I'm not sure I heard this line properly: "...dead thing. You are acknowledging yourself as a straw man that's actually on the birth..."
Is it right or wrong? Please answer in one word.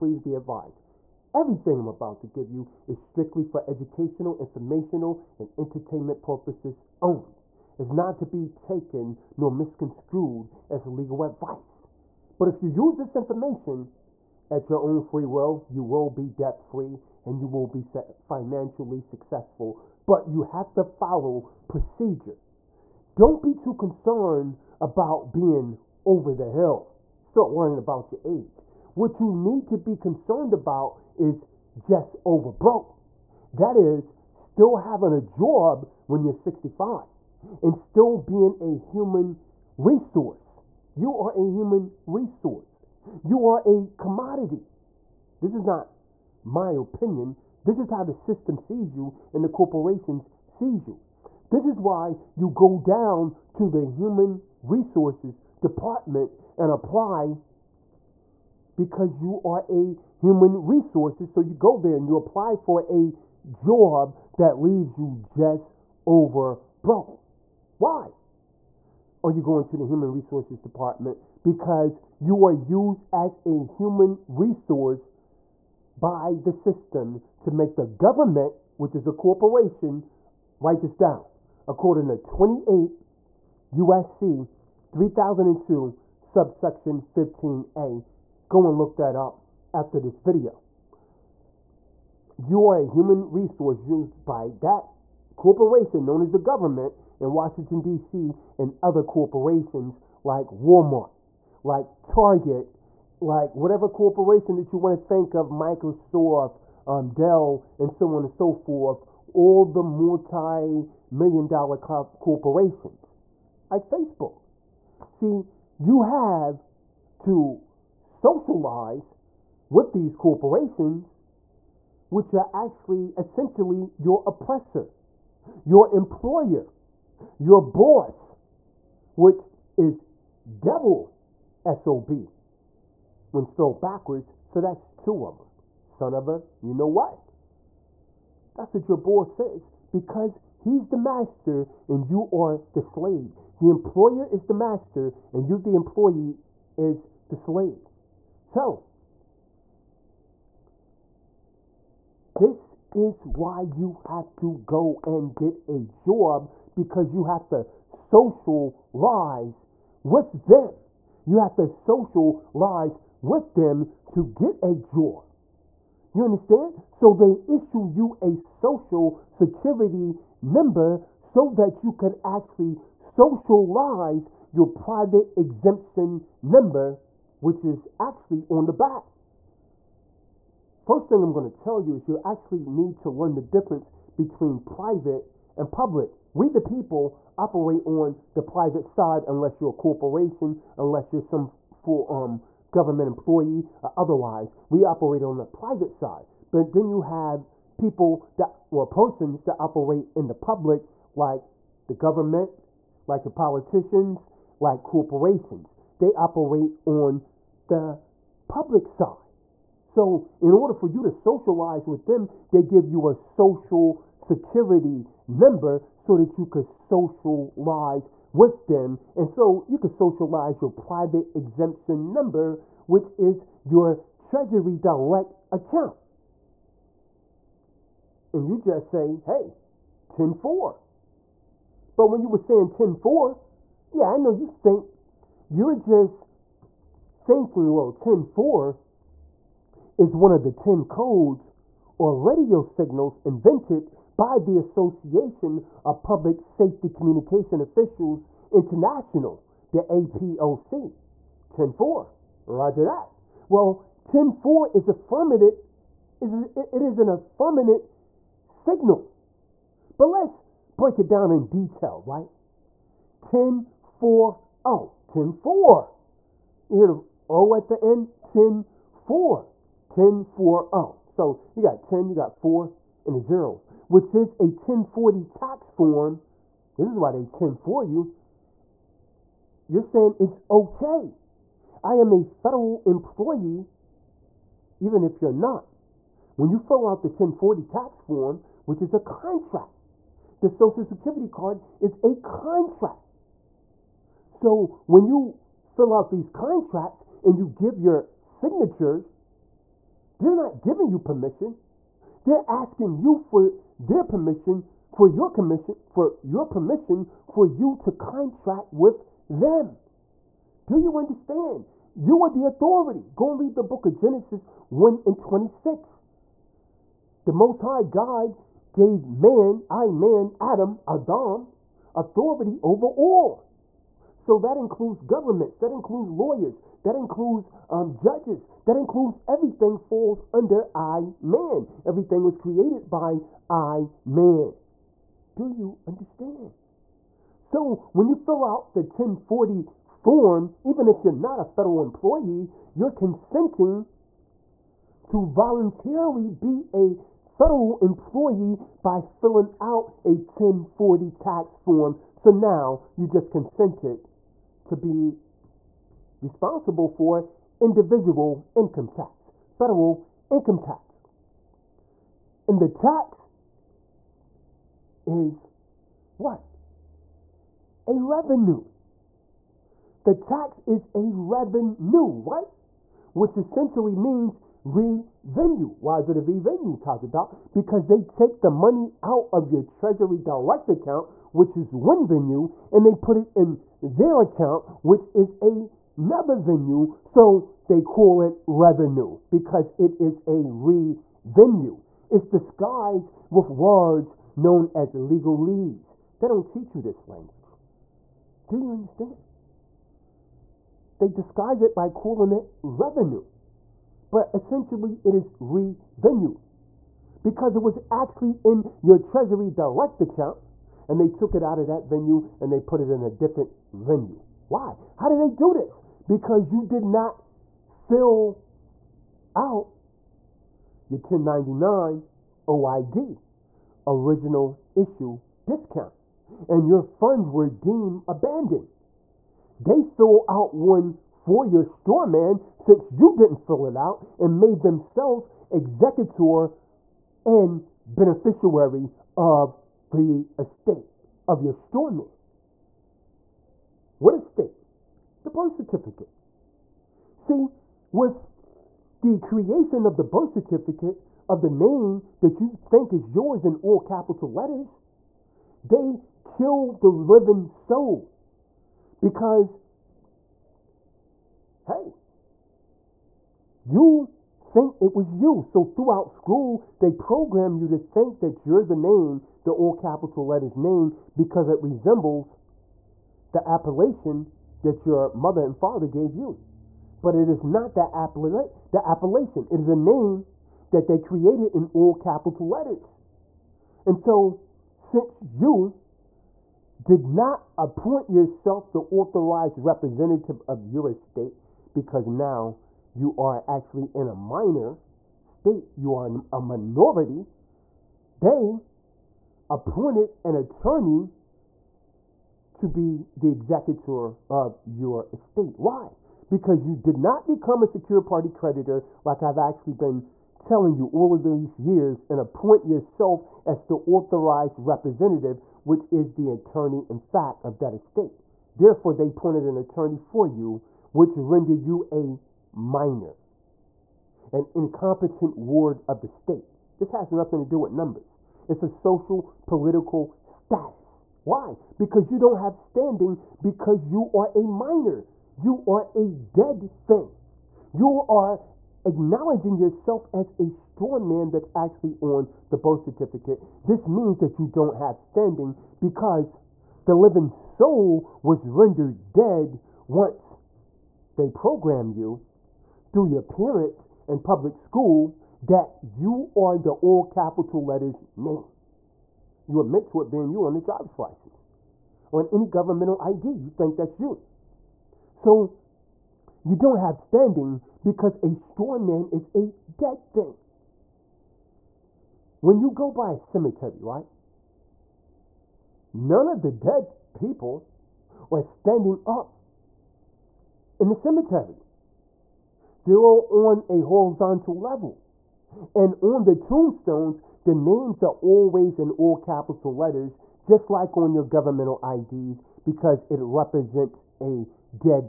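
right.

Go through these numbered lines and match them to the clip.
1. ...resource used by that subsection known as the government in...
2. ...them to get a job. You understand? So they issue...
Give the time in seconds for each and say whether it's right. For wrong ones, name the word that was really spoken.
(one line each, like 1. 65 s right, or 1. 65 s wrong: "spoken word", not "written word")
1. 93 s wrong: "corporation", not "subsection"
2. 163 s right.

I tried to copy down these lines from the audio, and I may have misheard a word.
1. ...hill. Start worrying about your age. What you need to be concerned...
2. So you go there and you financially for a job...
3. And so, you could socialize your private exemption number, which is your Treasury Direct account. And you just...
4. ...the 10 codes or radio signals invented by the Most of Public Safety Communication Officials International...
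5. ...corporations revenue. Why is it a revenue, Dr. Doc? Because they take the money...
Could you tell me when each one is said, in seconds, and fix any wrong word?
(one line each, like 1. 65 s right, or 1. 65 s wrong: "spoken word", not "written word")
1. 26 s right
2. 61 s wrong: "apply", not "financially"
3. 219 s right
4. 240 s wrong: "Association", not "Most"
5. 373 s wrong: "means", not "corporations".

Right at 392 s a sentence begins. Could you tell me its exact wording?
It's disguised with words known as legalese.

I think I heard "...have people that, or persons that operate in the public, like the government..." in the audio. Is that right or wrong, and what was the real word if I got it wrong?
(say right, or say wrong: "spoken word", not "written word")
right.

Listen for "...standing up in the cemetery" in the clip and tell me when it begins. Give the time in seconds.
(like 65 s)
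578 s.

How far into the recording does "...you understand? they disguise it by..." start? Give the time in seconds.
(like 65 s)
398 s.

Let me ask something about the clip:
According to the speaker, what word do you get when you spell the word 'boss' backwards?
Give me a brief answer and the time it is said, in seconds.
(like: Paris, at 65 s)
devil, at 130 s.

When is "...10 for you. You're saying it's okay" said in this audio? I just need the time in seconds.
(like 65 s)
277 s.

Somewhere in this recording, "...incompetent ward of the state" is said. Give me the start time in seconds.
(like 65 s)
524 s.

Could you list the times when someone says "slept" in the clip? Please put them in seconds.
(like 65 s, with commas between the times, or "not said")
not said.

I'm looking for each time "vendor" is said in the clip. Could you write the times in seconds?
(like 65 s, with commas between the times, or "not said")
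not said.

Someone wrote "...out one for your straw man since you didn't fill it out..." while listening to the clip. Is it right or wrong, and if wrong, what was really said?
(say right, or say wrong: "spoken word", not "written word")
right.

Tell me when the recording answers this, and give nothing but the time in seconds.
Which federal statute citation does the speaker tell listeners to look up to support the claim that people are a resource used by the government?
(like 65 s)
82 s.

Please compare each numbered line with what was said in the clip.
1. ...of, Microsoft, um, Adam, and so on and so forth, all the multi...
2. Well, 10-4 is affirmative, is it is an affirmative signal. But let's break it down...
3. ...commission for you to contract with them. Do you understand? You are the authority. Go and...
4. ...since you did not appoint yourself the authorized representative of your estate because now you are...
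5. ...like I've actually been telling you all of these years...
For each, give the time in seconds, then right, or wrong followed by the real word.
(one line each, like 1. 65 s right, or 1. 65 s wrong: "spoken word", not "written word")
1. 105 s wrong: "Dell", not "Adam"
2. 253 s right
3. 306 s wrong: "permission", not "commission"
4. 484 s right
5. 509 s right.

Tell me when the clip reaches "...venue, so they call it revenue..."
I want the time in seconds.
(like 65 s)
386 s.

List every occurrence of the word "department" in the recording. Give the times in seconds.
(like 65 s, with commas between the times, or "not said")
55 s, 70 s.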